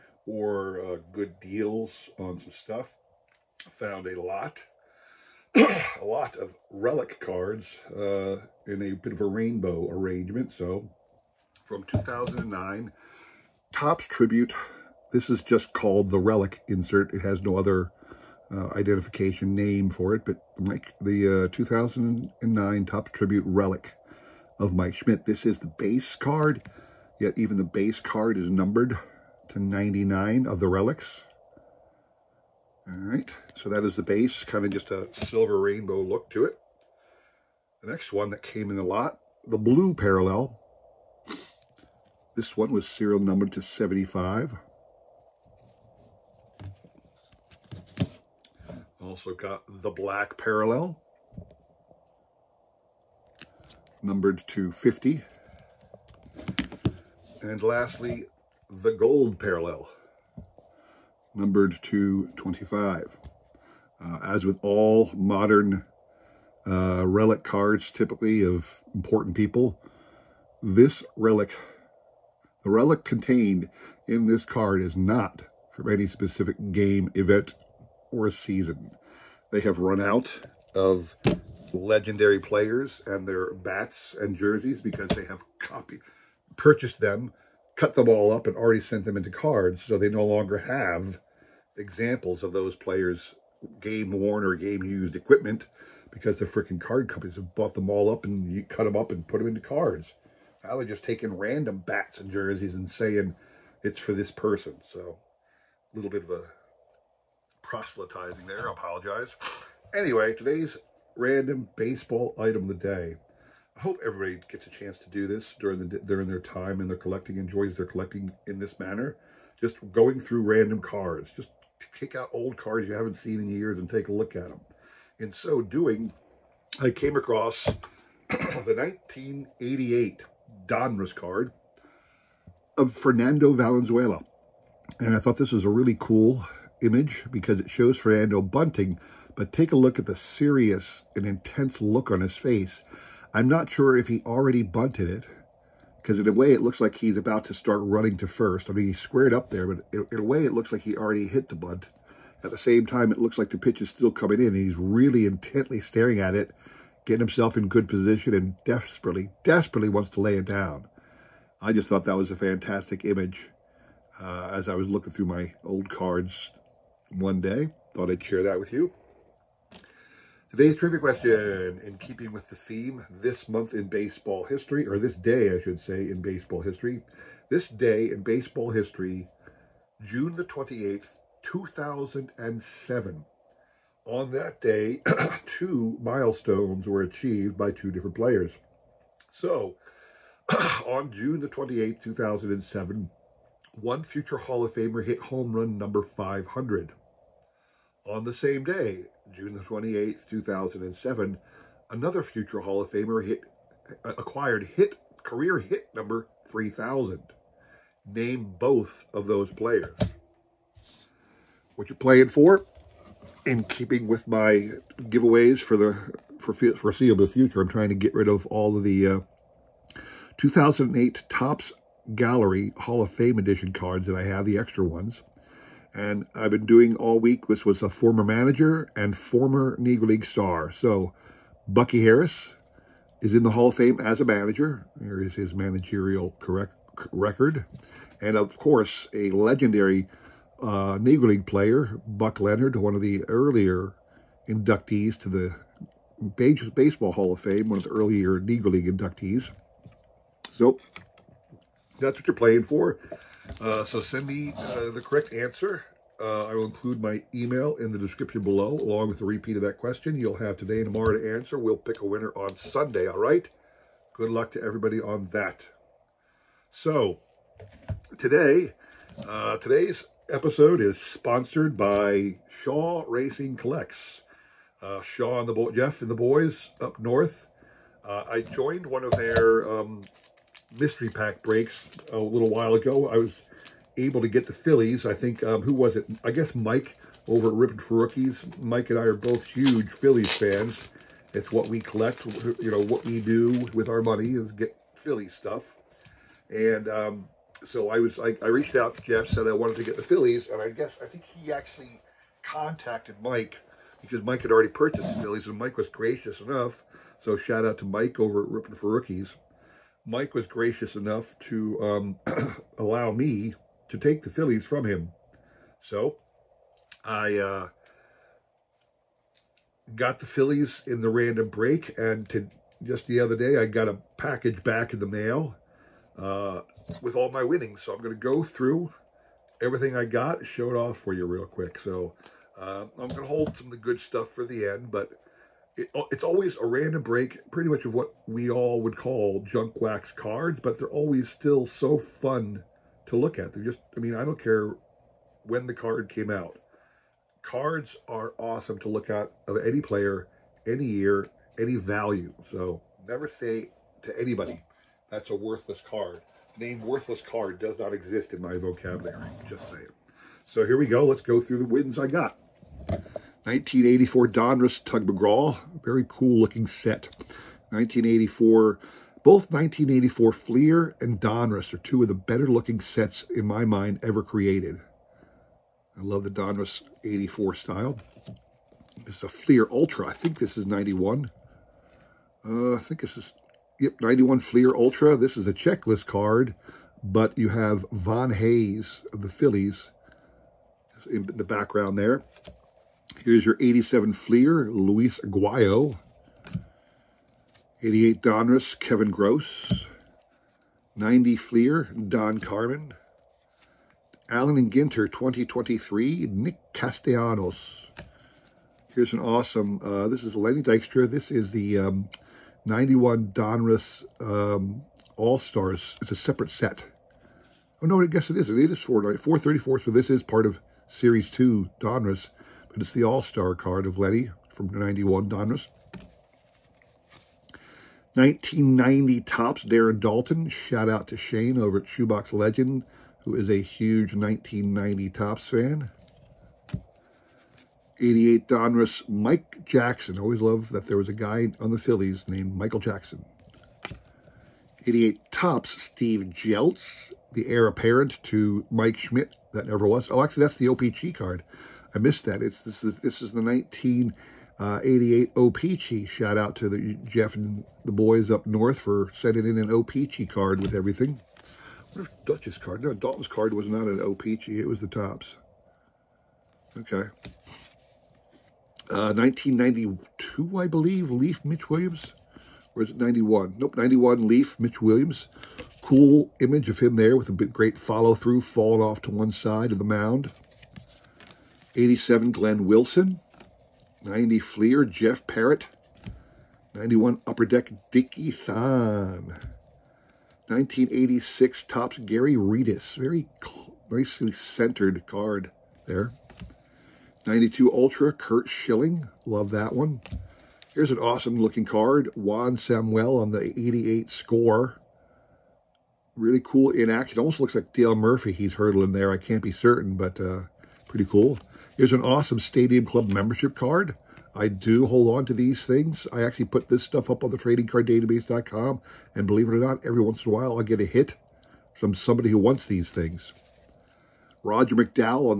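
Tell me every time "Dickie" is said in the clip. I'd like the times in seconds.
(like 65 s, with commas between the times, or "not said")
487 s.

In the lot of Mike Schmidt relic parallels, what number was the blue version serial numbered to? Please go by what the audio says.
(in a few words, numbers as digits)
75.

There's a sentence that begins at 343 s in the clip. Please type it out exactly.
They're just, I mean, I don't care when the card came out.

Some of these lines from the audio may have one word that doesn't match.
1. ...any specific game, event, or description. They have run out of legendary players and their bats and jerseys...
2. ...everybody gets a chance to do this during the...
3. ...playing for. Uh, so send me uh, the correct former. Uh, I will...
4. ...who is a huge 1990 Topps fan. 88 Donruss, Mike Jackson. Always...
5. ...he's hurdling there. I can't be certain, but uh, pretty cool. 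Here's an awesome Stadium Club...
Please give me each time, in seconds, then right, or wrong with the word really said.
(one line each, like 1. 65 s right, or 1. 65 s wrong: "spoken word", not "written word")
1. 75 s wrong: "season", not "description"
2. 114 s right
3. 252 s wrong: "answer", not "former"
4. 433 s right
5. 508 s right.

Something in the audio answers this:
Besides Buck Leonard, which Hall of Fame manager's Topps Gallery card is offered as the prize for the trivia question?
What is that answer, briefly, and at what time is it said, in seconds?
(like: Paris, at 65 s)
Bucky Harris, at 231 s.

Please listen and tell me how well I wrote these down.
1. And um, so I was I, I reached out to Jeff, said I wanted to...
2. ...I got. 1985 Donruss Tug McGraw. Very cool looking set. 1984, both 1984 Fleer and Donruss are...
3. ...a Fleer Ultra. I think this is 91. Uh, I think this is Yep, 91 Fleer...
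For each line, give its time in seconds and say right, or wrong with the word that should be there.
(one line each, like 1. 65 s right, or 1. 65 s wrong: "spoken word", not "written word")
1. 296 s right
2. 361 s wrong: "1984", not "1985"
3. 379 s right.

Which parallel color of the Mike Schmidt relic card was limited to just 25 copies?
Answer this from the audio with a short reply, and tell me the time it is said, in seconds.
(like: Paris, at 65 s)
gold, at 58 s.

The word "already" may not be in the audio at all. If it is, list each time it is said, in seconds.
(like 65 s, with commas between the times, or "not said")
88 s, 144 s, 150 s, 304 s.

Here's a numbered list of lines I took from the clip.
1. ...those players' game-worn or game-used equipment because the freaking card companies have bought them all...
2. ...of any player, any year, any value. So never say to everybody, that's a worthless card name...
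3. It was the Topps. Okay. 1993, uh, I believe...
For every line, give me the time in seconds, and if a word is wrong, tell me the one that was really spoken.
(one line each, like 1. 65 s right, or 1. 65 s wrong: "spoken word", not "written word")
1. 92 s right
2. 349 s wrong: "anybody", not "everybody"
3. 464 s wrong: "1992", not "1993".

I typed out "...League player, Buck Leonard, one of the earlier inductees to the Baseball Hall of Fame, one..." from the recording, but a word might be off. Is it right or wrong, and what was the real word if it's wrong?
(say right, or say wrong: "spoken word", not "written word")
right.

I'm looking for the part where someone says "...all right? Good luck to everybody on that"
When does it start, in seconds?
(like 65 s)
263 s.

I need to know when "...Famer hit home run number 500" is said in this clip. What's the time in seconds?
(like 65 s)
194 s.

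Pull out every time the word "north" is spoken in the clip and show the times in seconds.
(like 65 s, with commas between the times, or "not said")
276 s, 458 s.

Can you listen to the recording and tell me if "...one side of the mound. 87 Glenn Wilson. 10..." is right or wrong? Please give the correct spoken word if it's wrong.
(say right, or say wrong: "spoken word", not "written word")
wrong: "90", not "10".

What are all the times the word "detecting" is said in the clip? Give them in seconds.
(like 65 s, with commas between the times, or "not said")
not said.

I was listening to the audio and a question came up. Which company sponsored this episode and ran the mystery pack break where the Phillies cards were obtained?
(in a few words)
Shaw Racing Collects.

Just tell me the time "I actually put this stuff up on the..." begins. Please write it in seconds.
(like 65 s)
516 s.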